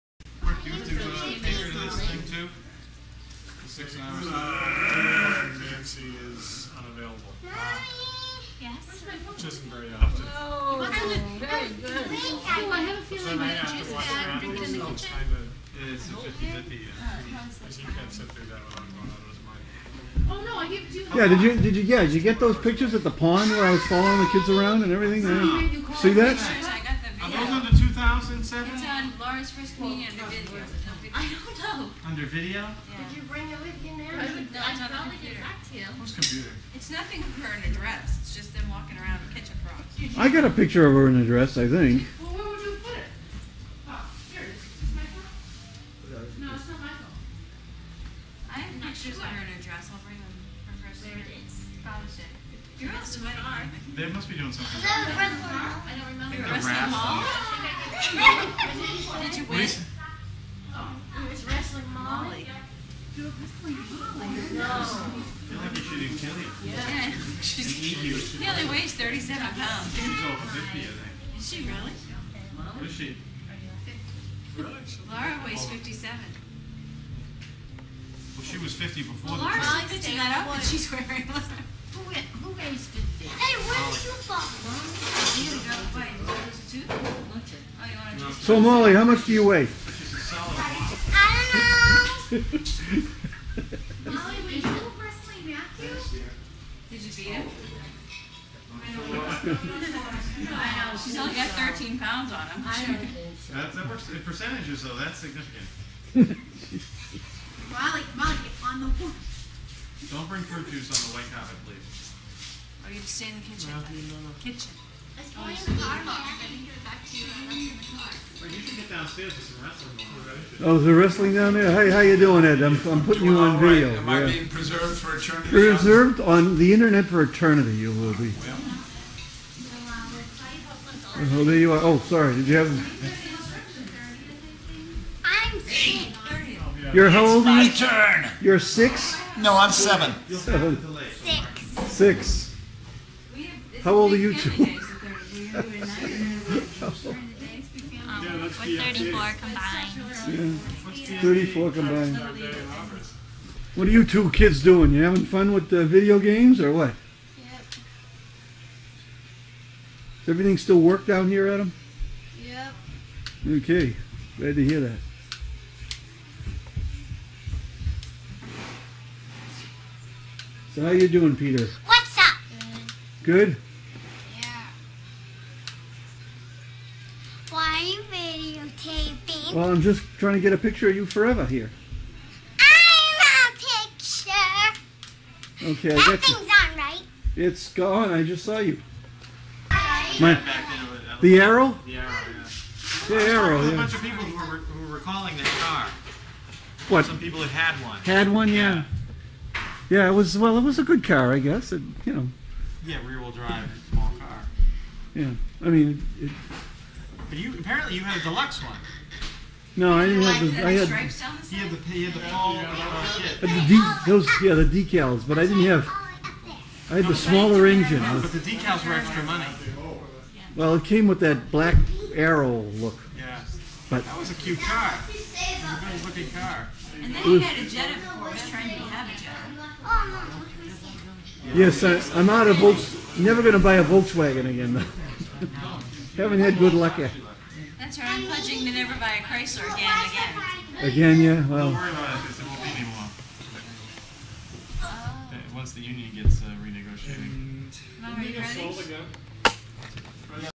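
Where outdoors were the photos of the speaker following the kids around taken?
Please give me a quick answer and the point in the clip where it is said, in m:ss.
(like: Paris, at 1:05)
pond, at 0:23.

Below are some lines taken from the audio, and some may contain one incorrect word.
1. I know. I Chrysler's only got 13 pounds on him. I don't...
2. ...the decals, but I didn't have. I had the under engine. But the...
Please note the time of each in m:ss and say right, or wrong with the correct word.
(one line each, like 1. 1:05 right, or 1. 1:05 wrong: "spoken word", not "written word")
1. 1:38 wrong: "She", not "Chrysler"
2. 3:34 wrong: "smaller", not "under".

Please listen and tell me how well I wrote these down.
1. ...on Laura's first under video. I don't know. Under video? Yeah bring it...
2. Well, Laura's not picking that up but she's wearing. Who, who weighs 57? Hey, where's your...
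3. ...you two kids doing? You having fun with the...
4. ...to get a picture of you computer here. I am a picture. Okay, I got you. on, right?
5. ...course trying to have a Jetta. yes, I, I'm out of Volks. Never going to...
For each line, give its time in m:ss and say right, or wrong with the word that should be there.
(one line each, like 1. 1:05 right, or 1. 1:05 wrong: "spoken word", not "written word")
1. 0:28 right
2. 1:19 wrong: "50", not "57"
3. 2:33 right
4. 3:00 wrong: "forever", not "computer"
5. 3:48 right.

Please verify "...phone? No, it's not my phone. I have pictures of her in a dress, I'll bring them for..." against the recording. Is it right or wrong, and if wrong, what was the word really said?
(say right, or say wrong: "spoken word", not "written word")
right.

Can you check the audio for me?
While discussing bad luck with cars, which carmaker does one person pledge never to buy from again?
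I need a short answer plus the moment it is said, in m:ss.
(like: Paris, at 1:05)
Chrysler, at 3:59.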